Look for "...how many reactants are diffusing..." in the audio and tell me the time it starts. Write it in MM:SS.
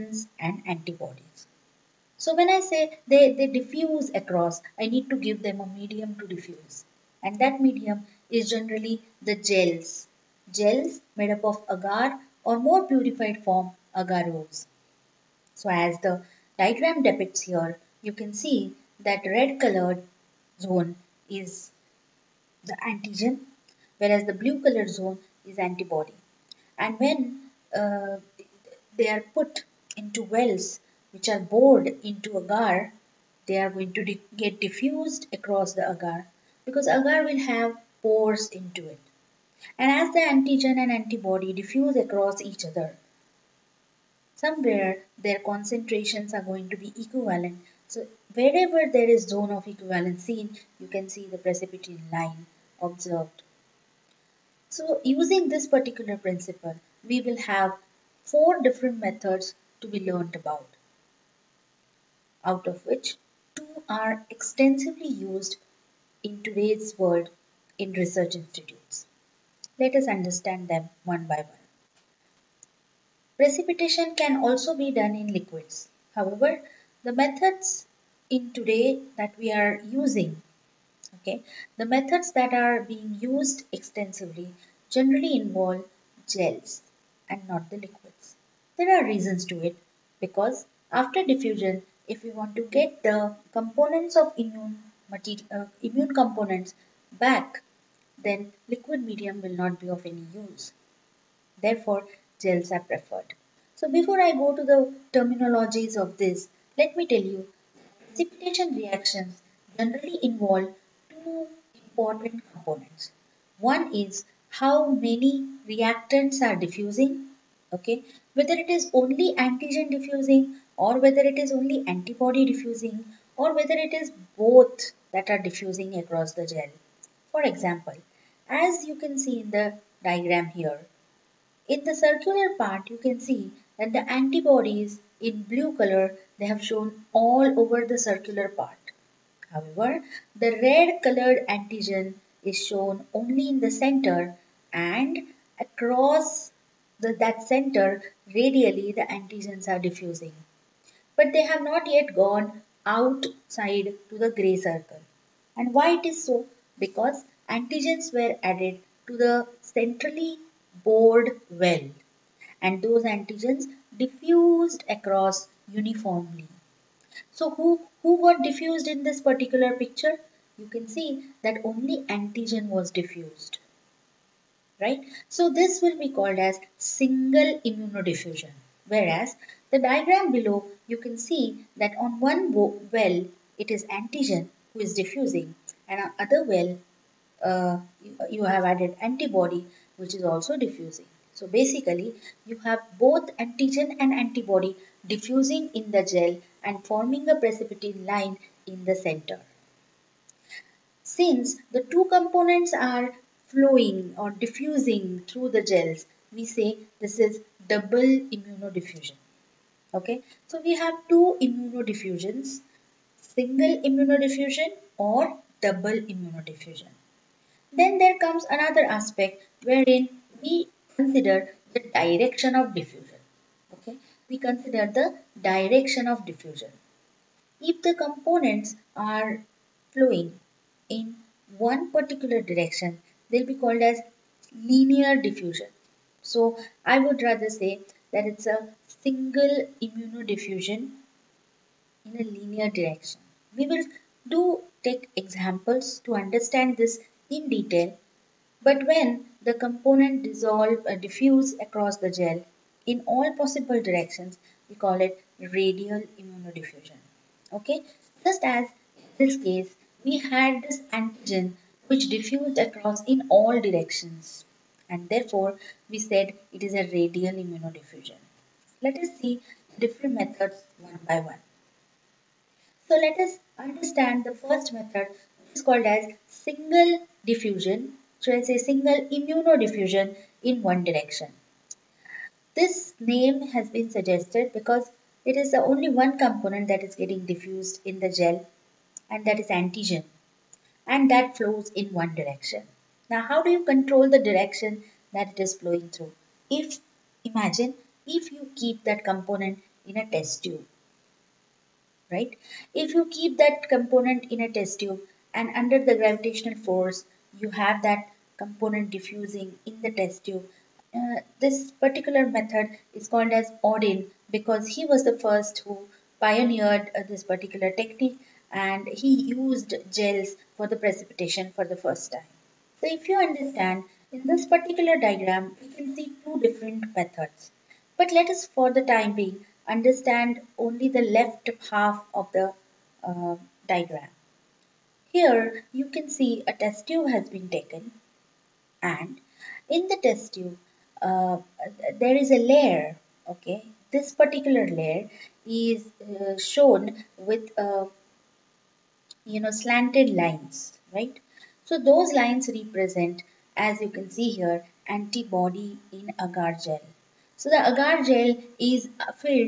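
01:54.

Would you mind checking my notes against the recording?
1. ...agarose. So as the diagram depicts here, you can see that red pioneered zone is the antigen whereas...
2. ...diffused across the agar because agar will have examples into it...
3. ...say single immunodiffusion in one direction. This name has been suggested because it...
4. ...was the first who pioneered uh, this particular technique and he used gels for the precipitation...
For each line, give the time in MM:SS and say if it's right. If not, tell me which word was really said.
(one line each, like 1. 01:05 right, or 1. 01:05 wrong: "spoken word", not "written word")
1. 00:13 wrong: "colored", not "pioneered"
2. 00:34 wrong: "pores", not "examples"
3. 04:38 right
4. 05:14 right.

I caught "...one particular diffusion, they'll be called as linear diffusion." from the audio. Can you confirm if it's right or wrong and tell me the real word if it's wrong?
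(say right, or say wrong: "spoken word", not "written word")
wrong: "direction", not "diffusion".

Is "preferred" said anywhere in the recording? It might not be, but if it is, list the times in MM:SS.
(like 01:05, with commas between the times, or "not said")
01:42.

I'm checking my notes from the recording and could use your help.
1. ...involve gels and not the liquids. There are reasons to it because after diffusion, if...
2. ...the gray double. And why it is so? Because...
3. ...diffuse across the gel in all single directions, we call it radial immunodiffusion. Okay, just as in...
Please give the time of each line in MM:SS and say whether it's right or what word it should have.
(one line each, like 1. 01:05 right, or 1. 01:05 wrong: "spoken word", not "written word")
1. 01:25 right
2. 02:34 wrong: "circle", not "double"
3. 04:10 wrong: "possible", not "single".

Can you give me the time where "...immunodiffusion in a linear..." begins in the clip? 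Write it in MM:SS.
03:59.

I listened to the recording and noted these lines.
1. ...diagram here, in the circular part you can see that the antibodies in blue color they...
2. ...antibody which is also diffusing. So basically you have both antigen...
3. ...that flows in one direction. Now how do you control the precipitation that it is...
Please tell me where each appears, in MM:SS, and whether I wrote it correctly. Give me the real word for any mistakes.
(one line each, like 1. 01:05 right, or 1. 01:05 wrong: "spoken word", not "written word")
1. 02:10 right
2. 03:09 right
3. 04:51 wrong: "direction", not "precipitation".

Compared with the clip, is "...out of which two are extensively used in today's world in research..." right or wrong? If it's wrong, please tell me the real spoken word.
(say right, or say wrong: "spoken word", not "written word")
right.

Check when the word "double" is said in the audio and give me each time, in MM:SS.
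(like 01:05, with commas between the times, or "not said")
03:27, 03:35.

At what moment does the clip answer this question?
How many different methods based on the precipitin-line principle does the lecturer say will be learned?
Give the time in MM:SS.
00:58.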